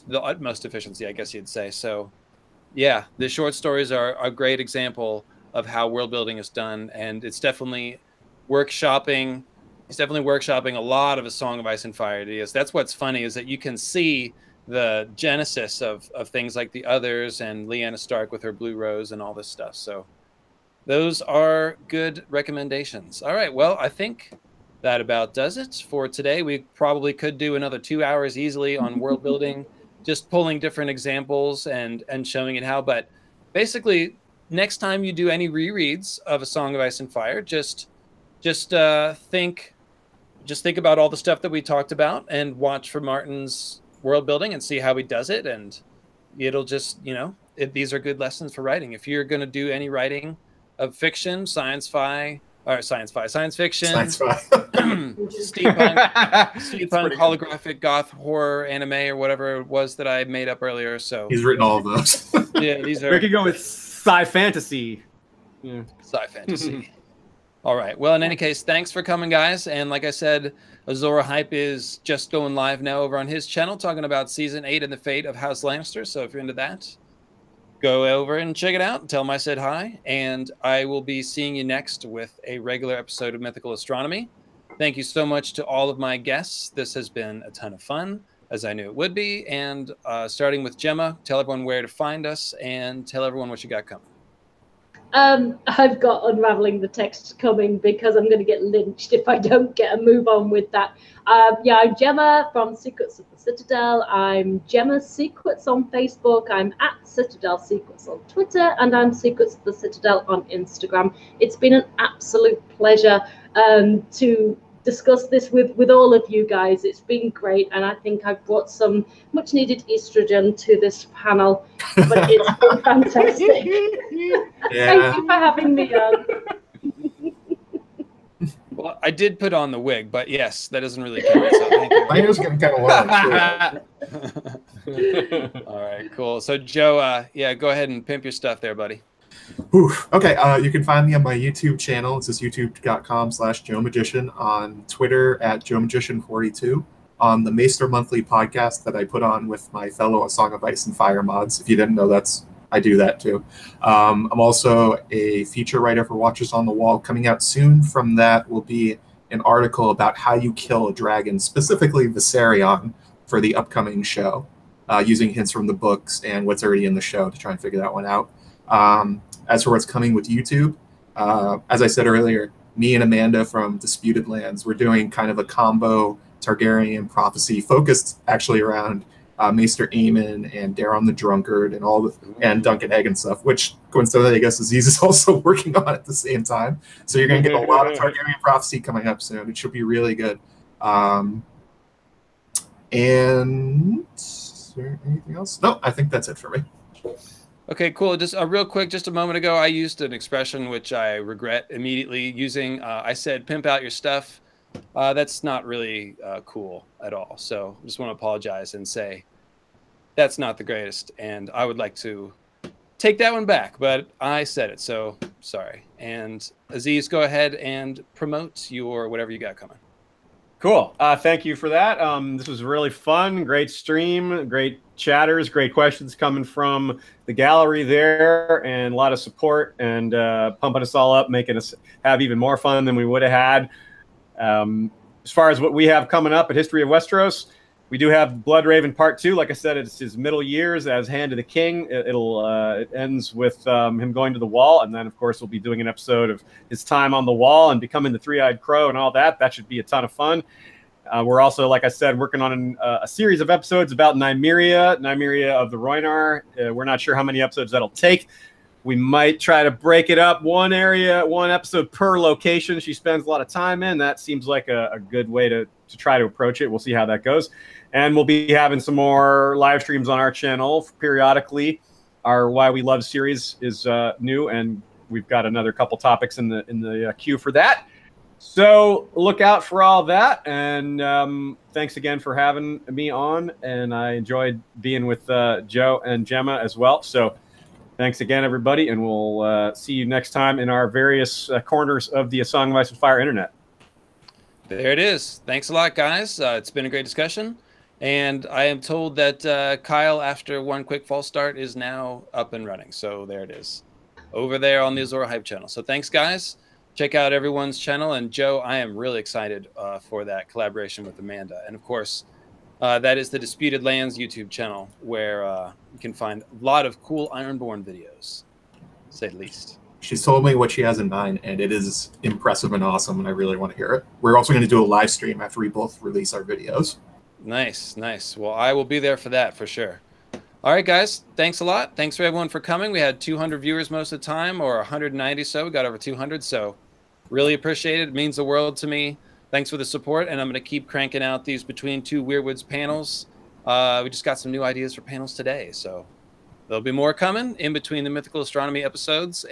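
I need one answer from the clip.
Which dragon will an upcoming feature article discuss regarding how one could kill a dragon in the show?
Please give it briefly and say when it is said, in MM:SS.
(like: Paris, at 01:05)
Viserion, at 02:42.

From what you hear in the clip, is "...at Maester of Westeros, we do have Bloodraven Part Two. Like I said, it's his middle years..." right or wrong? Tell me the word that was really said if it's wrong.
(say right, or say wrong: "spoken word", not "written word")
wrong: "History", not "Maester".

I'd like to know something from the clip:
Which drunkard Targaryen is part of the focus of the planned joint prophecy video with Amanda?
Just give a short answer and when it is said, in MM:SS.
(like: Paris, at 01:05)
Daeron the Drunkard, at 03:00.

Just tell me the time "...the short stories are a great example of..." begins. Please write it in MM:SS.
00:03.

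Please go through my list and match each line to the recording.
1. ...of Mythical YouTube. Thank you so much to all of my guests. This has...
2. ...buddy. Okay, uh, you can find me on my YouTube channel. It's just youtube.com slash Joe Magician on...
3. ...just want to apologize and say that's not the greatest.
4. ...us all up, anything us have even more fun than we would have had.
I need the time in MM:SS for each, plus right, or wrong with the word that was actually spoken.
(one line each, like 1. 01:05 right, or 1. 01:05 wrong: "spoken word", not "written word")
1. 01:23 wrong: "Astronomy", not "YouTube"
2. 02:18 right
3. 03:27 right
4. 03:50 wrong: "making", not "anything".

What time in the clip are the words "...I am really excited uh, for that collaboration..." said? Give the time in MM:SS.
05:08.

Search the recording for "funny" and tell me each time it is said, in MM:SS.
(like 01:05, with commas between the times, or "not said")
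00:12.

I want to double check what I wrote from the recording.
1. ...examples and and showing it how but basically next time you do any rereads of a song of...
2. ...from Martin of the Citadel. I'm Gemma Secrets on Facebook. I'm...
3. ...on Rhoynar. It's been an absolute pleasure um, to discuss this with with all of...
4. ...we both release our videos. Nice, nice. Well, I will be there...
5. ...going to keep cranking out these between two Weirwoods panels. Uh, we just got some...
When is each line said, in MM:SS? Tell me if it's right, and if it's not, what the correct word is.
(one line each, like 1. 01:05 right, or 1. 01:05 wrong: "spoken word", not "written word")
1. 00:30 right
2. 01:42 wrong: "Secrets", not "Martin"
3. 01:50 wrong: "Instagram", not "Rhoynar"
4. 05:25 right
5. 05:40 right.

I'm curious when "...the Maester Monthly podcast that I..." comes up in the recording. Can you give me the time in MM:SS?
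02:27.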